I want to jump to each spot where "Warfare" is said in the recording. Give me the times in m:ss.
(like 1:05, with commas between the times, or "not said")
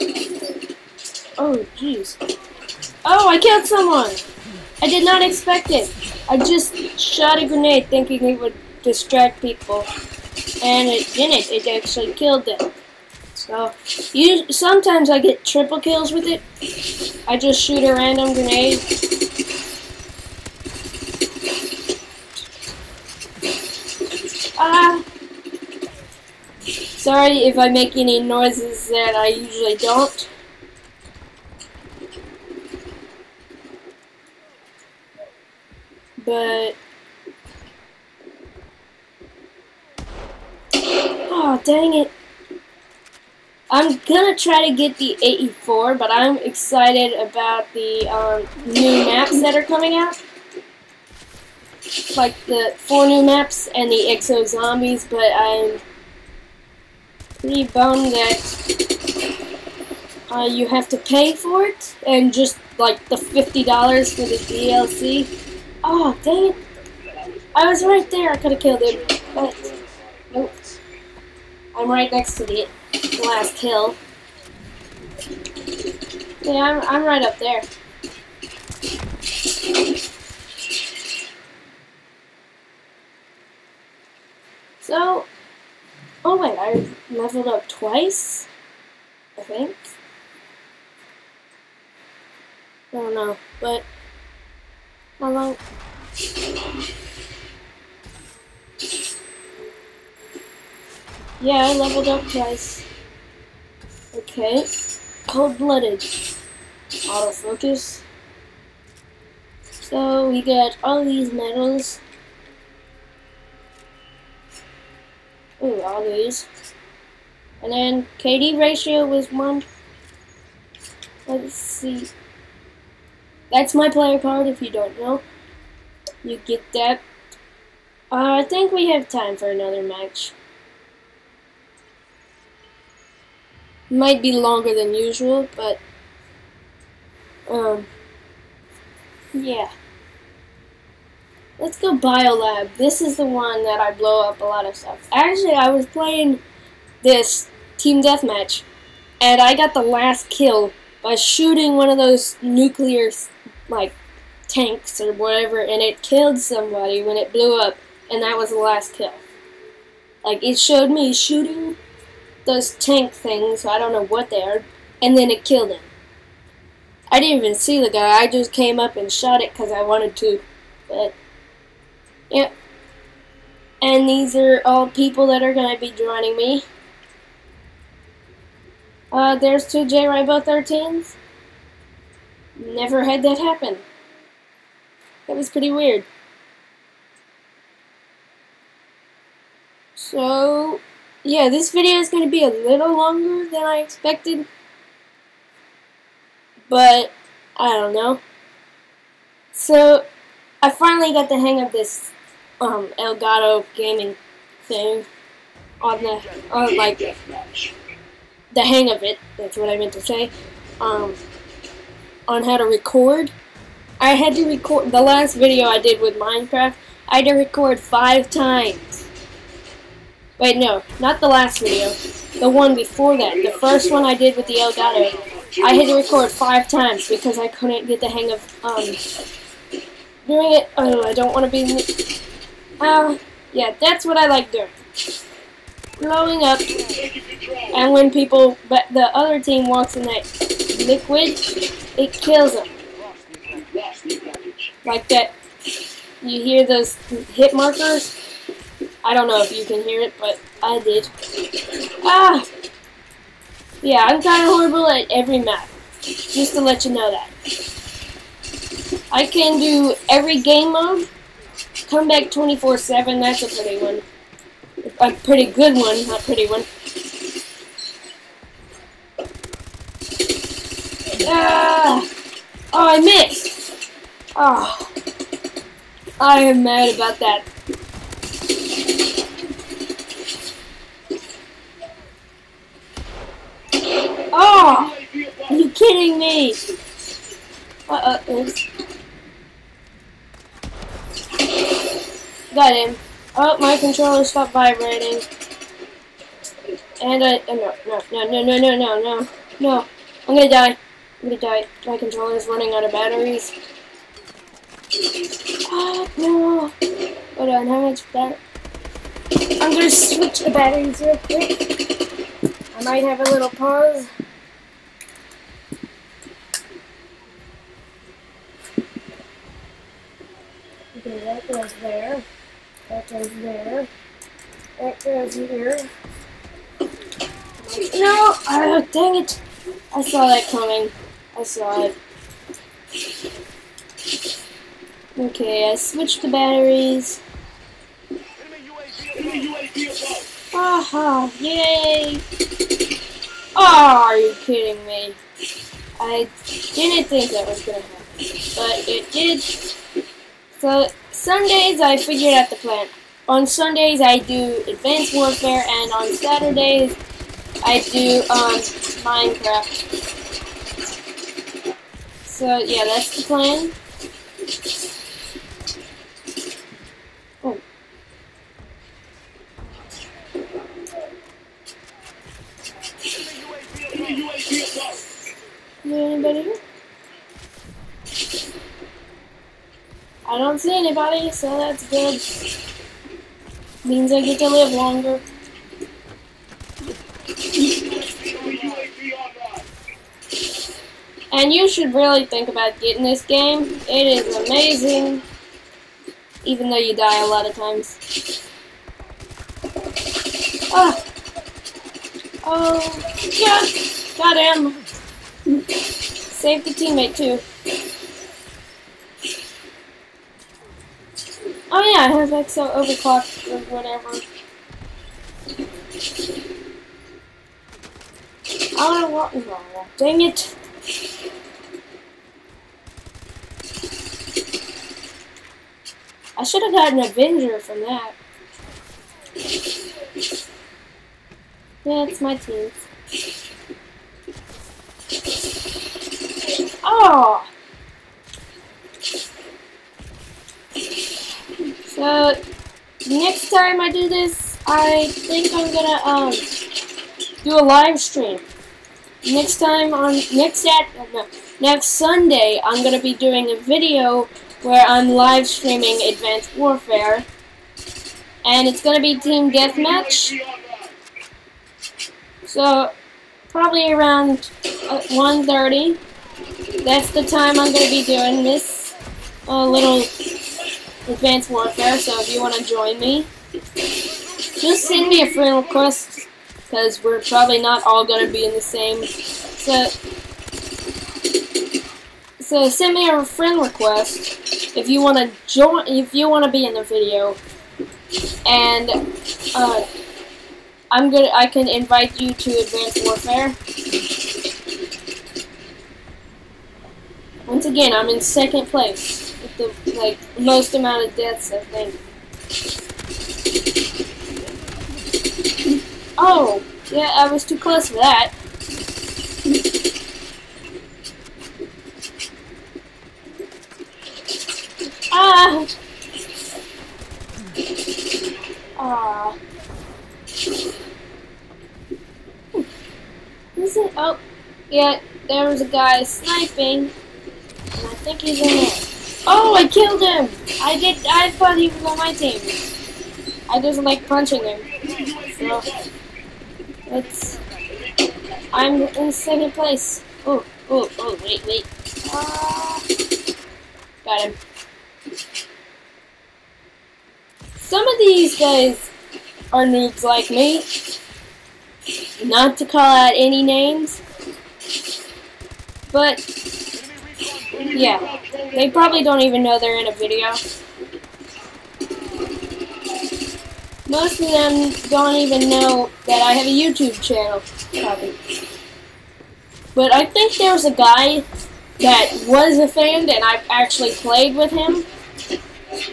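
5:55, 7:36, 7:51, 8:13.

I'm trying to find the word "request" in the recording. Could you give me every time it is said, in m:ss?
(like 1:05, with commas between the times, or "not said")
7:55, 8:03.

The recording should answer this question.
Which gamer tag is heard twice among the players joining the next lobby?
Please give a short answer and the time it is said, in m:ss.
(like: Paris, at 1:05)
J Rainbow 13, at 2:59.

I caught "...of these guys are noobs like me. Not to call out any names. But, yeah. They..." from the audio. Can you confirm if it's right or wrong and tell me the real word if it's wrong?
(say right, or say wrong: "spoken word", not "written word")
right.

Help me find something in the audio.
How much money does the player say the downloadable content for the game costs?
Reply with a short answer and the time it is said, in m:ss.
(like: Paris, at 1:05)
$50, at 1:03.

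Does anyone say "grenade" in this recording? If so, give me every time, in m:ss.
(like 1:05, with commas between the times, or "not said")
0:07, 0:18.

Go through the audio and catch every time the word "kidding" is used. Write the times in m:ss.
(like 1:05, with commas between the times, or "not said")
4:45, 5:44.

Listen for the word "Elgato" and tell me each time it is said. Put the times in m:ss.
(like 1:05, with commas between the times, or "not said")
3:22, 3:44.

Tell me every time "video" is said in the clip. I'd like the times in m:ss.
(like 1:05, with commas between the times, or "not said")
3:11, 3:35, 3:41, 7:33, 8:06, 9:19.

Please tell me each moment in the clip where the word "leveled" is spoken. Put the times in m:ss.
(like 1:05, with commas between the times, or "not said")
1:27, 1:41.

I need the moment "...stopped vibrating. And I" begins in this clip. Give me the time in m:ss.
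4:54.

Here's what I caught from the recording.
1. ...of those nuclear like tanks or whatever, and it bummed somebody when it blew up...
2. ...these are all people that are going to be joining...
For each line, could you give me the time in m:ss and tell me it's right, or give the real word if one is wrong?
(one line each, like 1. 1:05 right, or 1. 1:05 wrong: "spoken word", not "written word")
1. 2:31 wrong: "killed", not "bummed"
2. 2:54 right.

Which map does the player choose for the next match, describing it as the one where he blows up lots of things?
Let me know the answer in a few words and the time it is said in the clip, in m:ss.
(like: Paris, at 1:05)
Biolab, at 2:21.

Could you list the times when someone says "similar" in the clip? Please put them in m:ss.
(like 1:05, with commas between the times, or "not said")
not said.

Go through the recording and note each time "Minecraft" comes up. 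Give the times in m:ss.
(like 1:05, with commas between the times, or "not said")
3:36, 5:59.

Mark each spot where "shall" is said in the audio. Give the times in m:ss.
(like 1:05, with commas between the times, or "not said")
not said.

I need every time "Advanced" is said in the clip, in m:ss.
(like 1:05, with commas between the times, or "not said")
5:54, 7:36, 7:51, 8:12.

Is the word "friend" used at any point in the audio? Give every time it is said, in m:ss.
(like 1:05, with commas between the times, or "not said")
7:55, 8:03.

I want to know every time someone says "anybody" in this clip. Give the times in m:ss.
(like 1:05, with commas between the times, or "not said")
6:15, 6:20.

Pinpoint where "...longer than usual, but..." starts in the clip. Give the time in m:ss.
2:14.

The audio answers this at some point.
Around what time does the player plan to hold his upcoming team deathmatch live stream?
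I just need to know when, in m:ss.
7:44.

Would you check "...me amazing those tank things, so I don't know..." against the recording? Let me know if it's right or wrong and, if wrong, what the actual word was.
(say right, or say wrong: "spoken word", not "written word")
wrong: "shooting", not "amazing".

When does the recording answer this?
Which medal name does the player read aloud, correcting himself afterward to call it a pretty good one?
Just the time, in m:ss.
4:21.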